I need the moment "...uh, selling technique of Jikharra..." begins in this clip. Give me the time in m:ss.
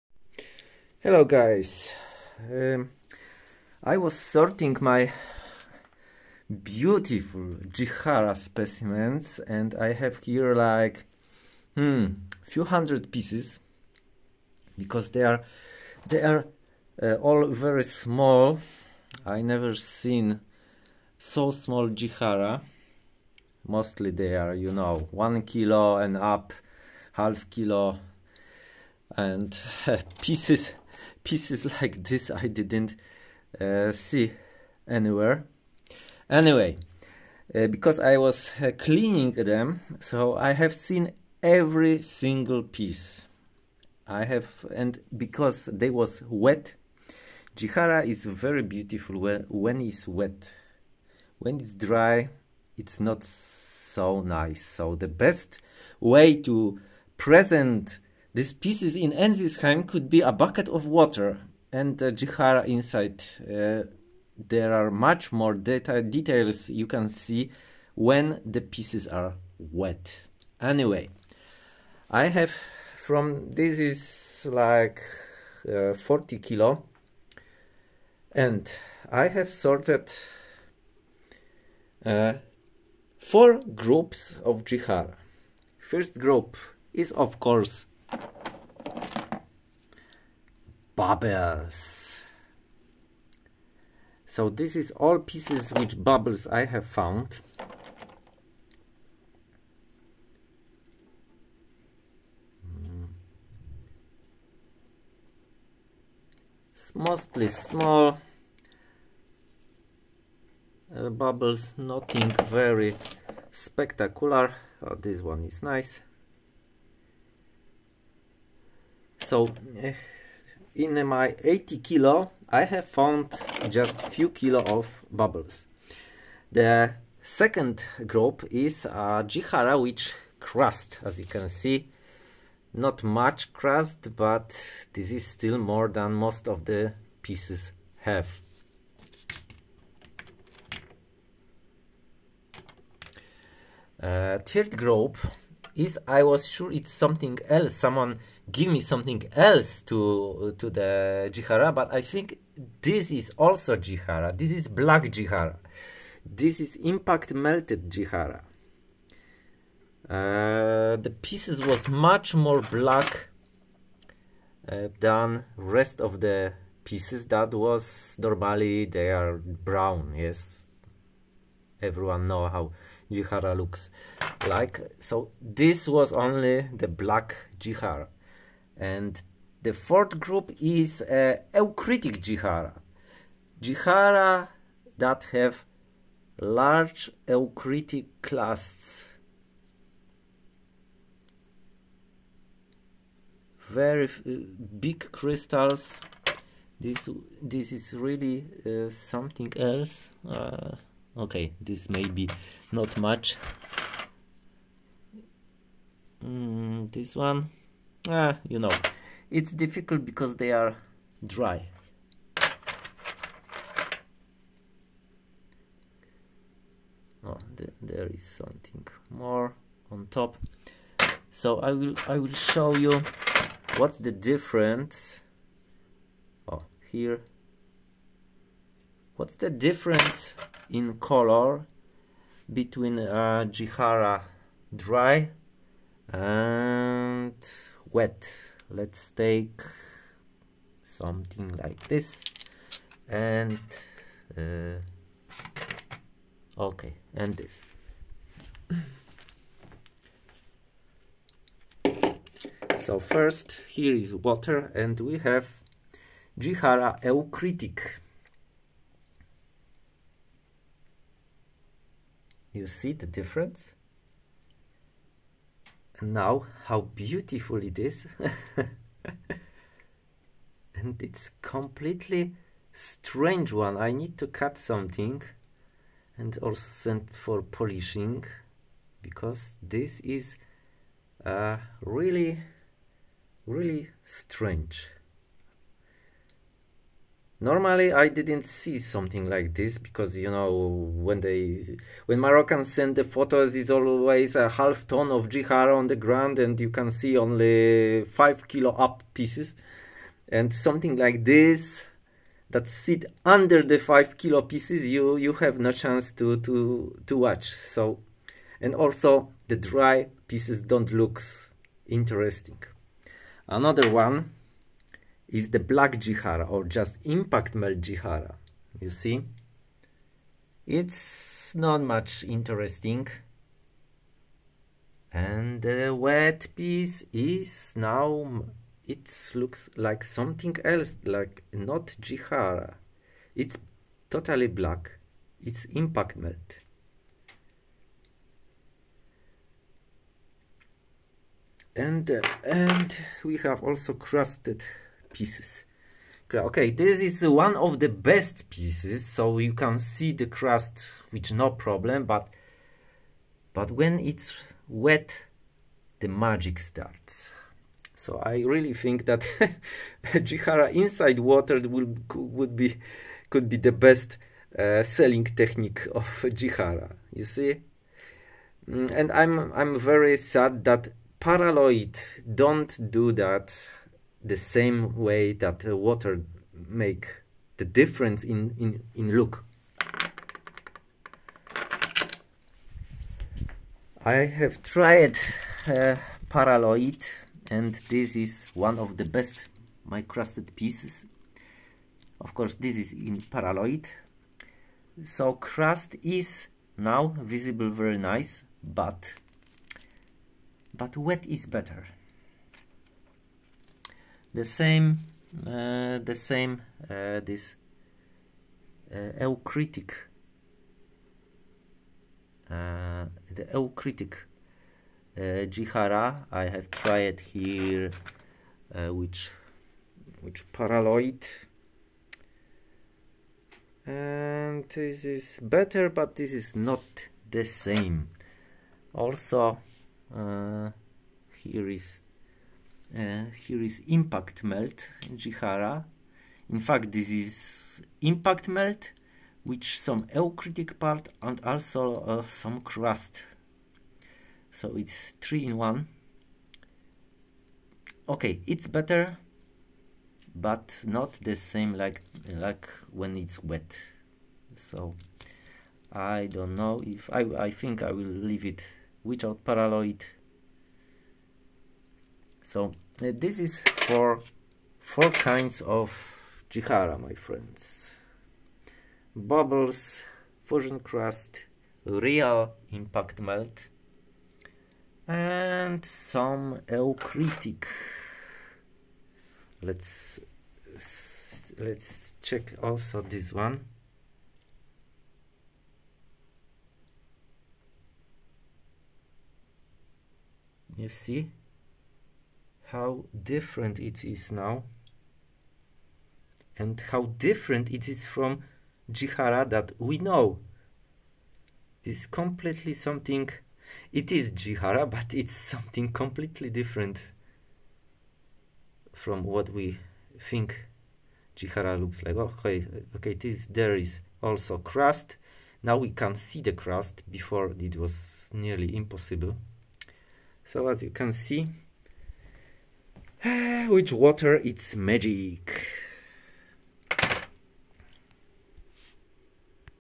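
6:04.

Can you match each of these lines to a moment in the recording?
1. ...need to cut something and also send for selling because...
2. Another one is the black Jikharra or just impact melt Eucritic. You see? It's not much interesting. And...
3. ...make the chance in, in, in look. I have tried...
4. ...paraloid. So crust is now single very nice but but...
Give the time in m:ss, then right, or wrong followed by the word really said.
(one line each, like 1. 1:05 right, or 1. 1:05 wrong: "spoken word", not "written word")
1. 4:33 wrong: "polishing", not "selling"
2. 5:13 wrong: "Jikharra", not "Eucritic"
3. 6:16 wrong: "difference", not "chance"
4. 6:33 wrong: "visible", not "single".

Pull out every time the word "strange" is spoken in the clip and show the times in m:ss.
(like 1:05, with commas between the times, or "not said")
4:32, 4:44.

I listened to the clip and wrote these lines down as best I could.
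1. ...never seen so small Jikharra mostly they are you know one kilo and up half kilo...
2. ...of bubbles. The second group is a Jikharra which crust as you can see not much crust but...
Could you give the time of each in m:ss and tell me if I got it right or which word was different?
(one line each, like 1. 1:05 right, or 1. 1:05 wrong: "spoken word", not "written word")
1. 0:19 right
2. 2:04 right.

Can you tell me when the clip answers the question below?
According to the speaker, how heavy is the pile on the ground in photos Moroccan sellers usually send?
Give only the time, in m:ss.
4:54.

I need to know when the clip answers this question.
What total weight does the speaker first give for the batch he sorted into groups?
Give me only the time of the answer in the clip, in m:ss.
1:15.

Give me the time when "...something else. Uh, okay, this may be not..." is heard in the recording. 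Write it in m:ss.
3:18.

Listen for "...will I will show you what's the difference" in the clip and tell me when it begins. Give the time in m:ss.
3:41.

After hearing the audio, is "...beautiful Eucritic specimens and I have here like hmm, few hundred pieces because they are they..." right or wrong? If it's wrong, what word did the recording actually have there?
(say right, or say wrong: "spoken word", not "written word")
wrong: "Jikharra", not "Eucritic".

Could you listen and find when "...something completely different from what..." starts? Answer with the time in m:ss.
8:25.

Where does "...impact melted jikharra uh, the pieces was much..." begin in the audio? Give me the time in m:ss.
2:36.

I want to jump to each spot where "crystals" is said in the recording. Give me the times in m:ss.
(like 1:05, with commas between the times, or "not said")
3:15.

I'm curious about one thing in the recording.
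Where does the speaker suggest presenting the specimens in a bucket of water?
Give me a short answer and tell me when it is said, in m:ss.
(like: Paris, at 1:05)
Ensisheim, at 0:59.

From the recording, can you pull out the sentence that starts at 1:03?
Uh, there are much more data details you can see when the pieces are wet.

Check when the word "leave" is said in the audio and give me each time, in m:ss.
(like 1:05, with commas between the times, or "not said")
7:38.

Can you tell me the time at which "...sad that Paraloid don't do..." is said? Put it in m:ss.
6:10.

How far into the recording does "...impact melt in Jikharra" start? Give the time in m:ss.
7:13.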